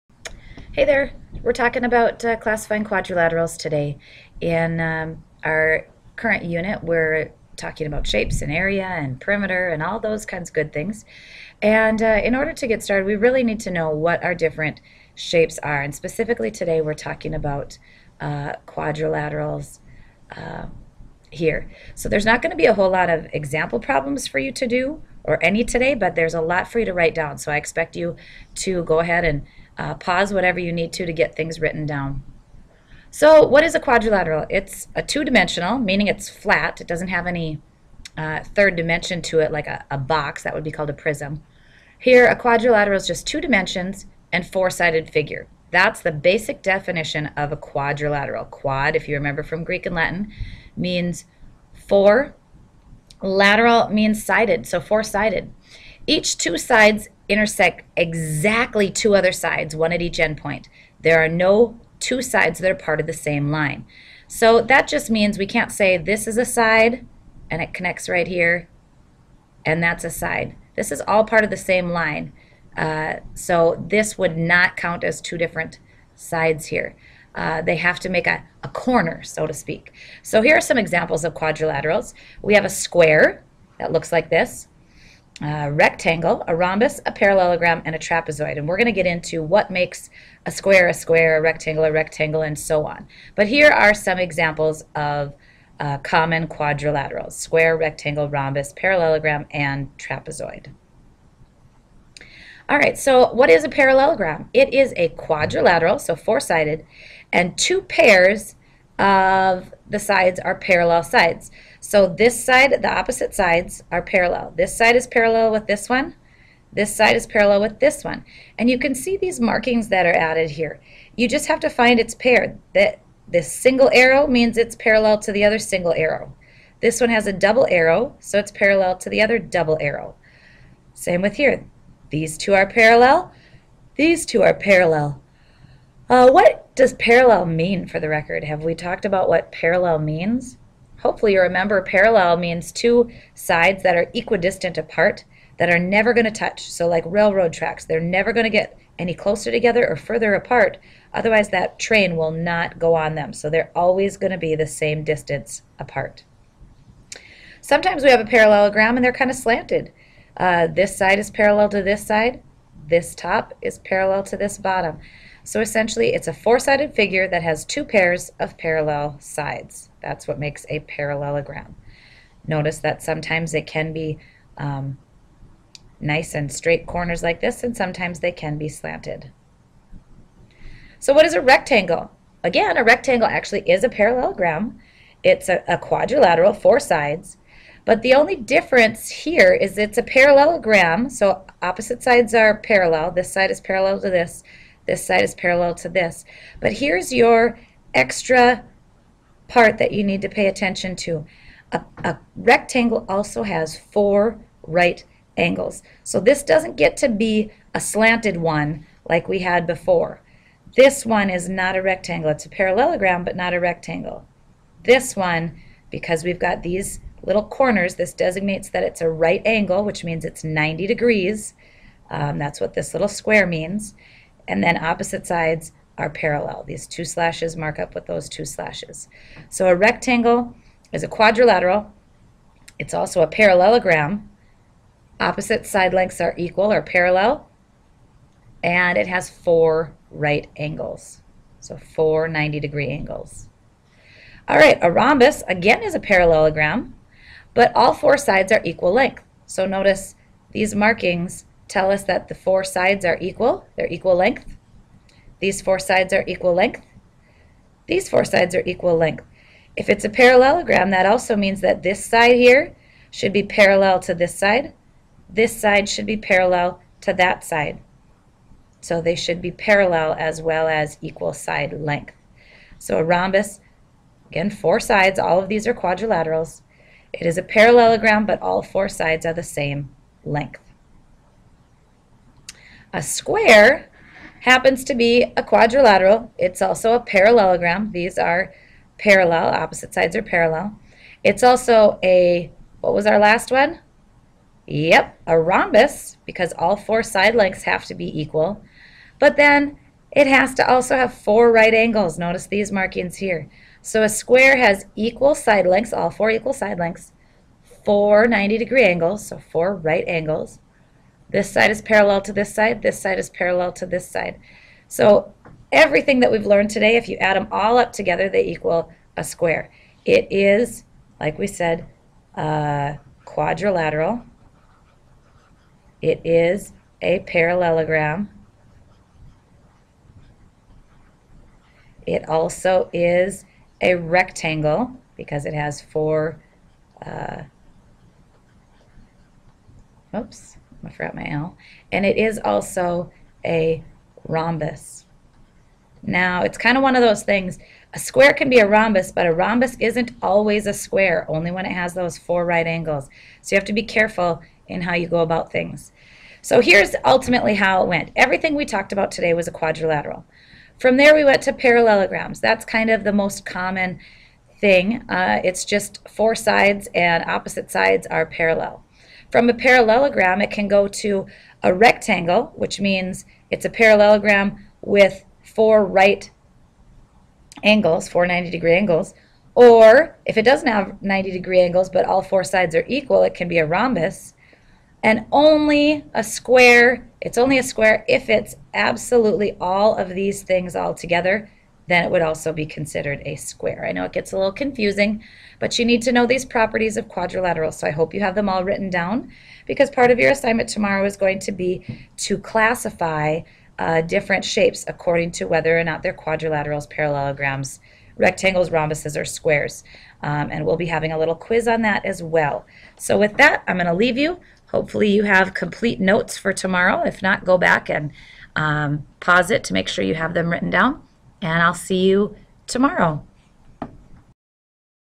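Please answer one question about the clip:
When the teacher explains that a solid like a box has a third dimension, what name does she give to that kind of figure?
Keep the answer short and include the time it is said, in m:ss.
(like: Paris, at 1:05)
prism, at 0:40.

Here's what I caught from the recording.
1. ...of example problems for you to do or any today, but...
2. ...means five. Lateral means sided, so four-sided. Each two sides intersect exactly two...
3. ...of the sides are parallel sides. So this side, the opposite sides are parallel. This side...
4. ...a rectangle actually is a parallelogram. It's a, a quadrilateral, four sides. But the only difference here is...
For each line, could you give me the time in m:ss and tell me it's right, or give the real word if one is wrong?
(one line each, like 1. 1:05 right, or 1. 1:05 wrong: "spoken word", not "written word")
1. 0:23 right
2. 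0:50 wrong: "four", not "five"
3. 1:48 right
4. 3:02 right.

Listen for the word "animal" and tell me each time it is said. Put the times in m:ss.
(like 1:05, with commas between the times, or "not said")
not said.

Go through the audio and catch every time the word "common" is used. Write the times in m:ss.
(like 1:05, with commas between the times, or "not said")
1:35, 6:03.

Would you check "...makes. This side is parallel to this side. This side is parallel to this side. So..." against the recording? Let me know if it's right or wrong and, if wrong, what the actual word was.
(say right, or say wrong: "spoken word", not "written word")
wrong: "angles", not "makes".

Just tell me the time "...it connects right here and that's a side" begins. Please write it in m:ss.
1:07.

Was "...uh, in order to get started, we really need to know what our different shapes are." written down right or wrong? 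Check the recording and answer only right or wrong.
right.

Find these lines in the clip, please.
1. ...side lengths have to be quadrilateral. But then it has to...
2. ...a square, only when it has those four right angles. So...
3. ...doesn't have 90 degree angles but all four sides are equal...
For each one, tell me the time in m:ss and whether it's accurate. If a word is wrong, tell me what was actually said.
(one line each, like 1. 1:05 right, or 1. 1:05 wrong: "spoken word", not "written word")
1. 4:57 wrong: "equal", not "quadrilateral"
2. 5:50 right
3. 6:20 right.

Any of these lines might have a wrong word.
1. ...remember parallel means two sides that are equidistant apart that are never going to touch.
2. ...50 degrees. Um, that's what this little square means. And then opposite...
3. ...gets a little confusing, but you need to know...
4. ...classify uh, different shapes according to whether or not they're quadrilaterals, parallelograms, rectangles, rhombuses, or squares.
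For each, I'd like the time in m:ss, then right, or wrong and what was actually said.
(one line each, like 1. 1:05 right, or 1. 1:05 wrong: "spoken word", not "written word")
1. 2:21 right
2. 3:40 wrong: "90", not "50"
3. 6:34 right
4. 6:42 right.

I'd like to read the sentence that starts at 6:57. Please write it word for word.
If not, go back and um, pause it to make sure you have them written down and I'll see you tomorrow.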